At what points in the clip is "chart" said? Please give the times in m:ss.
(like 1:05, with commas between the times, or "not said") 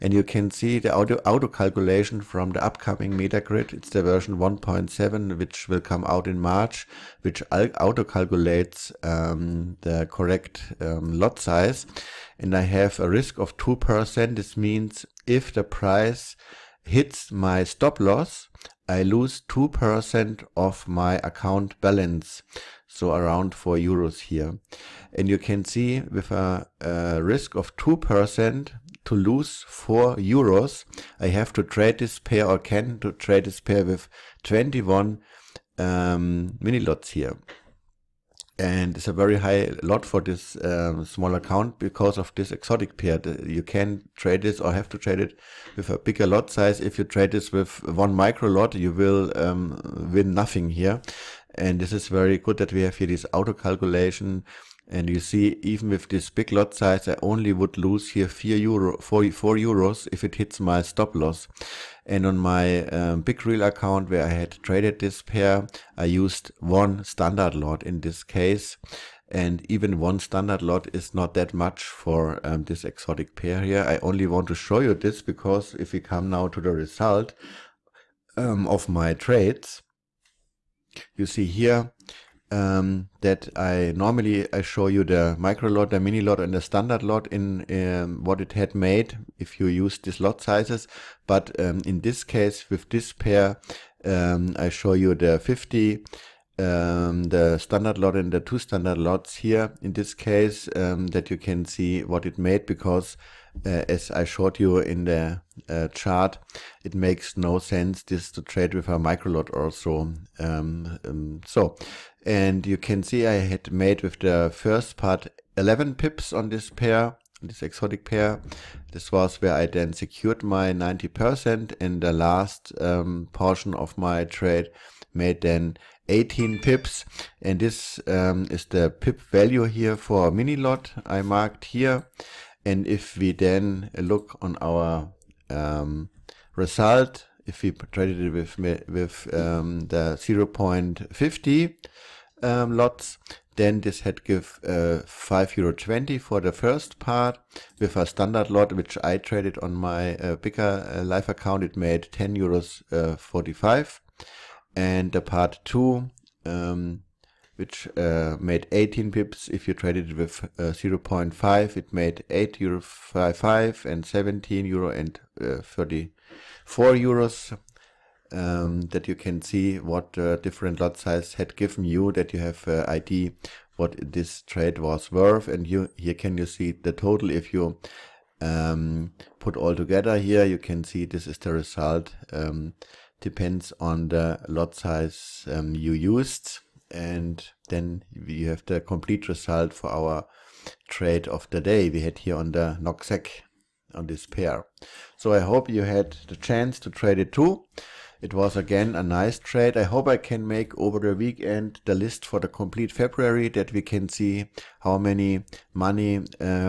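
1:45.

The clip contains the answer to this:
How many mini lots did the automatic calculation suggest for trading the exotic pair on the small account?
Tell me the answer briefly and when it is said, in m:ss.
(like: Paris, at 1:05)
21, at 0:34.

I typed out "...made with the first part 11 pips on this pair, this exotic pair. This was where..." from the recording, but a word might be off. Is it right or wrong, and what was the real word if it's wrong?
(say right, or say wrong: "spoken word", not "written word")
right.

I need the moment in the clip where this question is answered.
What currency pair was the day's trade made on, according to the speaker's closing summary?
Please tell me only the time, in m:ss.
3:12.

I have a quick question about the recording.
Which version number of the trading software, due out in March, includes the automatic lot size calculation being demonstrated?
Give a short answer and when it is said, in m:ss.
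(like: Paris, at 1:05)
1.7, at 0:04.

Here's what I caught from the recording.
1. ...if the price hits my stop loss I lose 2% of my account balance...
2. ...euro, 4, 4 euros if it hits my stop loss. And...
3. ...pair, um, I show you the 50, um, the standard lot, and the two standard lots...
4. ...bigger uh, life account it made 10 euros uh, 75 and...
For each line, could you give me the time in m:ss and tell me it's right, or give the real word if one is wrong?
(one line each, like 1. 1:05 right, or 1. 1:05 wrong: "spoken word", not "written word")
1. 0:15 right
2. 0:58 right
3. 1:33 right
4. 2:30 wrong: "45", not "75".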